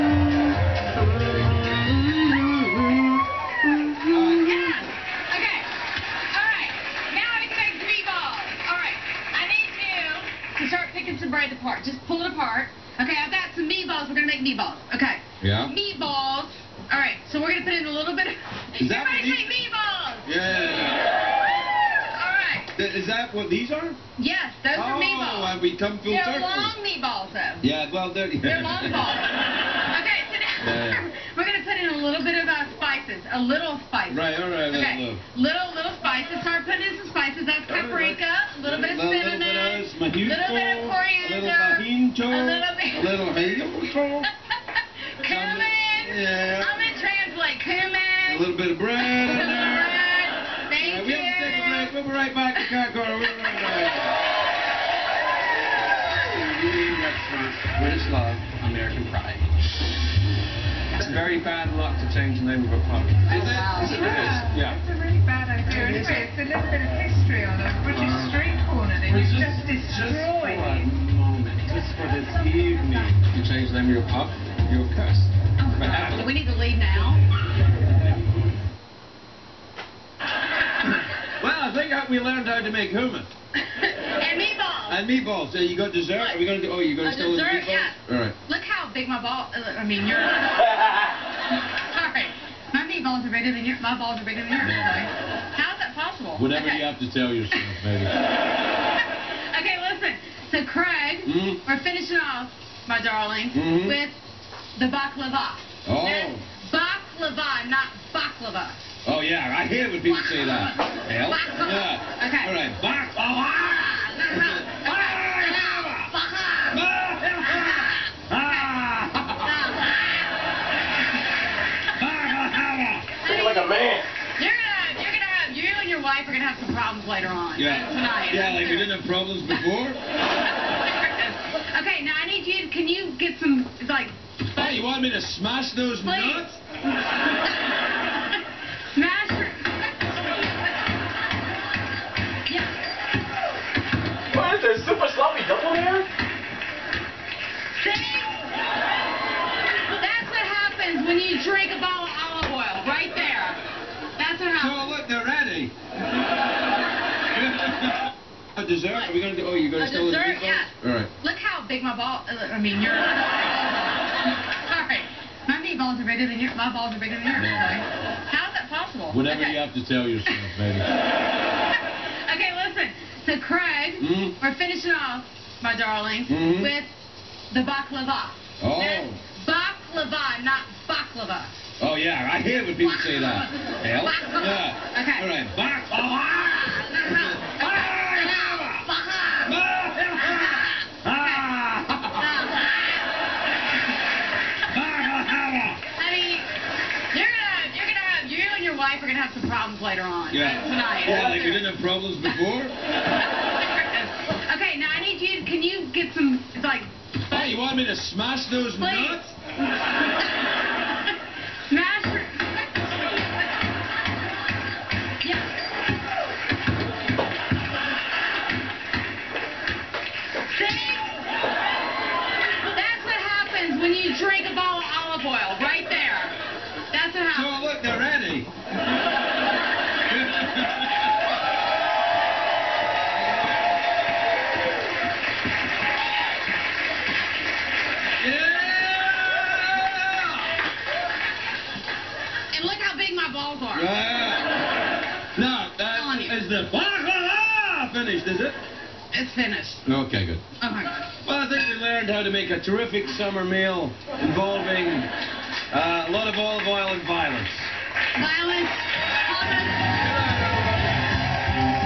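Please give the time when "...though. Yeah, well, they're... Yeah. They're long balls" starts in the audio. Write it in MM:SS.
00:27.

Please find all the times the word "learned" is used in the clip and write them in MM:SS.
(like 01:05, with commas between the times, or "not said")
01:22, 04:11.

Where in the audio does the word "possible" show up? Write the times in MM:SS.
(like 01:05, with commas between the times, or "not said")
01:35, 02:48.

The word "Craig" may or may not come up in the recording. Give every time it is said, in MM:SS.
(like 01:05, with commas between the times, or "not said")
01:40, 02:53.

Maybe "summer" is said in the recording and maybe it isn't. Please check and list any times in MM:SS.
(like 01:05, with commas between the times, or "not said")
04:13.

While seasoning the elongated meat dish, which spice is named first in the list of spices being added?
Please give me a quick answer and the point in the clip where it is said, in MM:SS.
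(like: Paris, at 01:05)
paprika, at 00:37.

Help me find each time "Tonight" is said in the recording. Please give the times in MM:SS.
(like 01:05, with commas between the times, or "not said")
02:07, 03:20.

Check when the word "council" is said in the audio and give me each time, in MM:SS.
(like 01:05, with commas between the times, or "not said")
not said.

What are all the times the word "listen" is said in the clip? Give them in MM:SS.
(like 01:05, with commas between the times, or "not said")
01:39, 02:52.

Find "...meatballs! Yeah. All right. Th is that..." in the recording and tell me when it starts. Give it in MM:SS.
00:19.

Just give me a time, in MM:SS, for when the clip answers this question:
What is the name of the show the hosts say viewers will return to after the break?
00:52.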